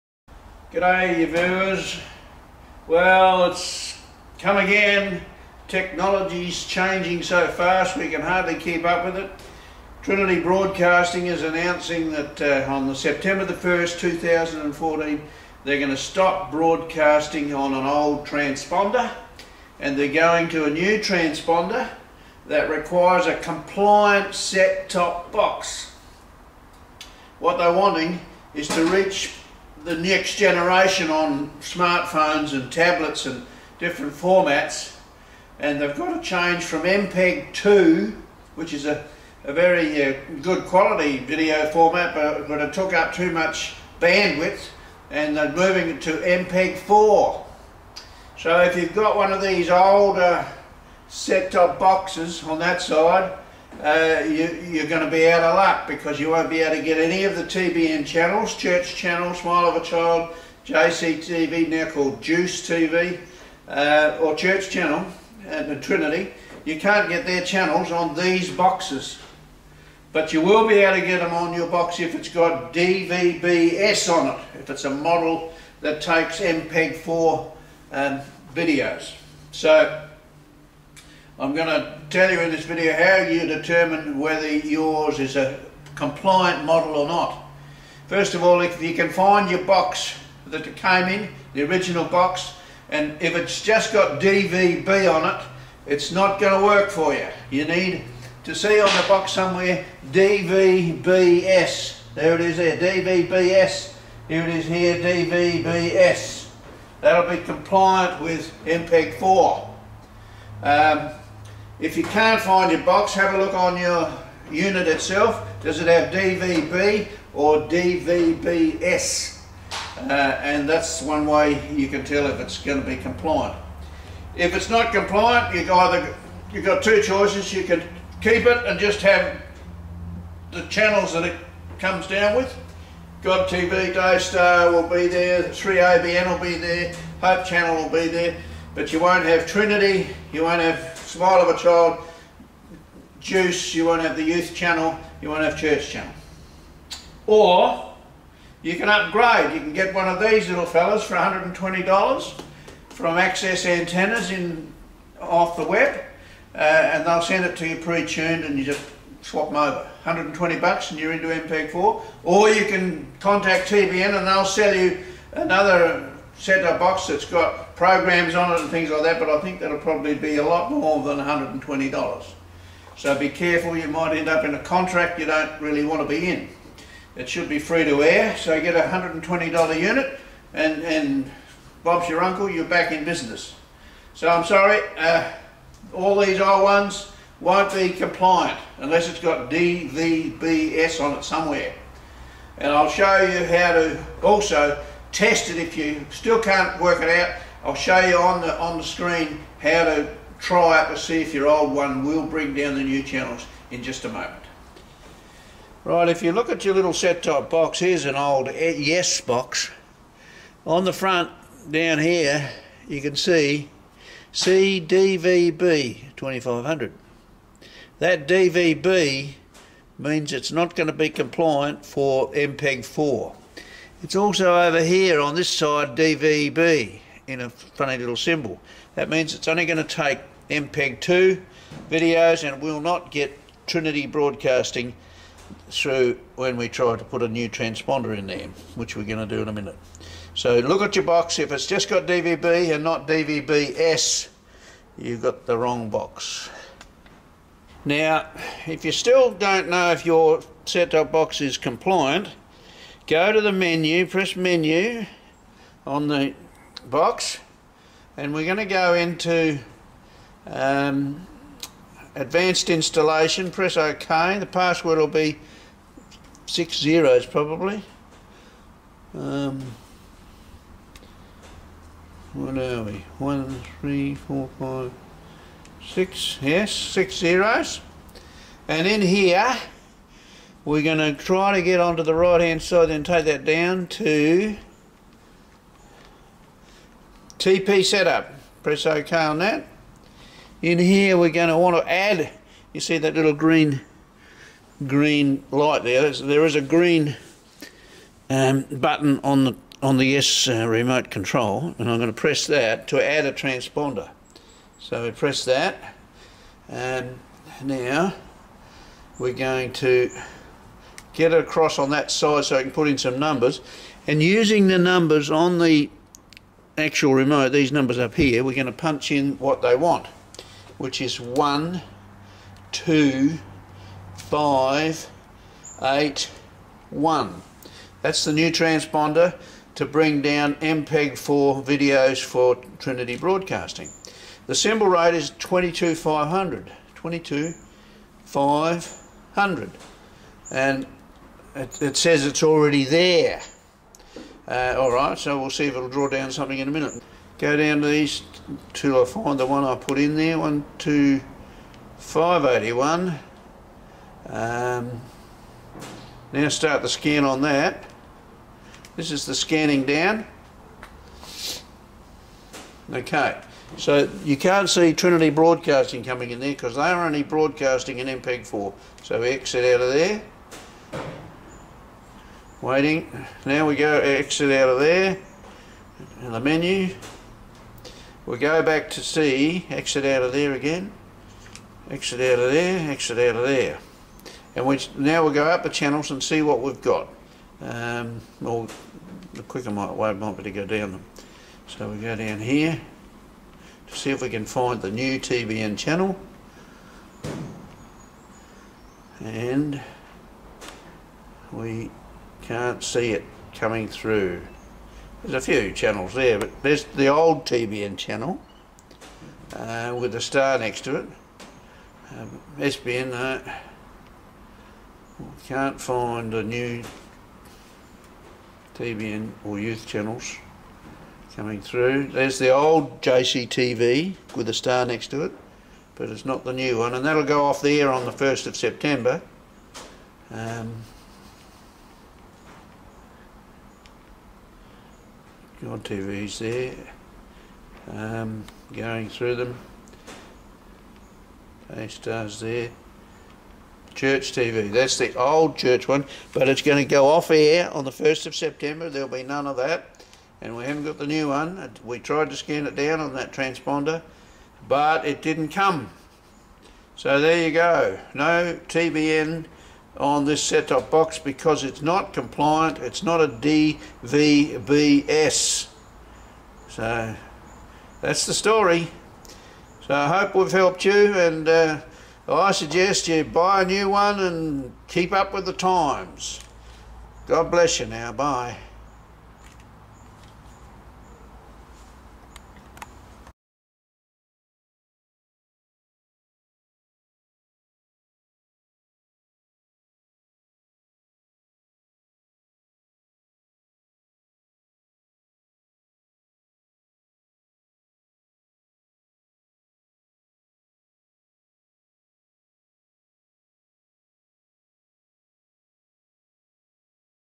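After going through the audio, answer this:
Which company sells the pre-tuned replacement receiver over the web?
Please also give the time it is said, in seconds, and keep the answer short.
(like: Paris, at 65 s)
Access Antennas, at 153 s.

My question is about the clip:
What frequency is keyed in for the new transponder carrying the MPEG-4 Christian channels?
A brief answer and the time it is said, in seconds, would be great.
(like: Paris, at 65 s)
12581, at 321 s.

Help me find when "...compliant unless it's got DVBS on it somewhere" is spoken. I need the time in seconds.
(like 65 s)
187 s.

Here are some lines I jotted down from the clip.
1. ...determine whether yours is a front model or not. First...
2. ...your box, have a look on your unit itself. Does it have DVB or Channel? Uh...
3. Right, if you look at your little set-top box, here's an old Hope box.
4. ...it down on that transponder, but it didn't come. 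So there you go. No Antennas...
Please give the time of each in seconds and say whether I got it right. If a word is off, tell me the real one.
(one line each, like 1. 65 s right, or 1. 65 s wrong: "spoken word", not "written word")
1. 83 s wrong: "compliant", not "front"
2. 112 s wrong: "DVBS", not "Channel"
3. 205 s wrong: "Yes", not "Hope"
4. 452 s wrong: "TBN", not "Antennas".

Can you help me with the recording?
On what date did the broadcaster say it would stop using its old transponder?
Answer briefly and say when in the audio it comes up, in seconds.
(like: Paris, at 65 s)
September 1st, 2014, at 12 s.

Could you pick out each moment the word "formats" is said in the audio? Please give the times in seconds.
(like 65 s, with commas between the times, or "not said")
34 s, 41 s.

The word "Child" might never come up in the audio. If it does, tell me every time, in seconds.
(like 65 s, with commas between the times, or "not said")
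59 s, 141 s.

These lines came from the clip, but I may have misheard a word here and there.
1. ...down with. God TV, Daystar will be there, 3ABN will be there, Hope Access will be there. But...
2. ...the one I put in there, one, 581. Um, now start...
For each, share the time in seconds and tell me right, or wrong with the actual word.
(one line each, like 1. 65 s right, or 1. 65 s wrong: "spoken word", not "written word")
1. 132 s wrong: "Channel", not "Access"
2. 349 s right.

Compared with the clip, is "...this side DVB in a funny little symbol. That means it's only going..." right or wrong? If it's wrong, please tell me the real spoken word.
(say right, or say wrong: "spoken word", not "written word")
right.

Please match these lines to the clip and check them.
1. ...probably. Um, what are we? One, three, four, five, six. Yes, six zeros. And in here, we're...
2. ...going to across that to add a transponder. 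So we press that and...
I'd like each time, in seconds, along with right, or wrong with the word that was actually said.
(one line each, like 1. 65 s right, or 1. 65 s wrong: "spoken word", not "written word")
1. 267 s right
2. 301 s wrong: "press", not "across".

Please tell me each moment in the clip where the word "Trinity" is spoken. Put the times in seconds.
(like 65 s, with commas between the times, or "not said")
10 s, 65 s, 139 s, 233 s, 332 s, 364 s.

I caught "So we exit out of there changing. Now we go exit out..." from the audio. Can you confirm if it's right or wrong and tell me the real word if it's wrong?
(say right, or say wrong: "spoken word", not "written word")
wrong: "waiting", not "changing".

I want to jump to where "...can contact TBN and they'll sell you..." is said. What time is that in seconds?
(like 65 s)
162 s.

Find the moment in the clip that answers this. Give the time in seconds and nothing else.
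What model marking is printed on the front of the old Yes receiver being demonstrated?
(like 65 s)
214 s.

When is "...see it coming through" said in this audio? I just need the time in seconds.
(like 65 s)
402 s.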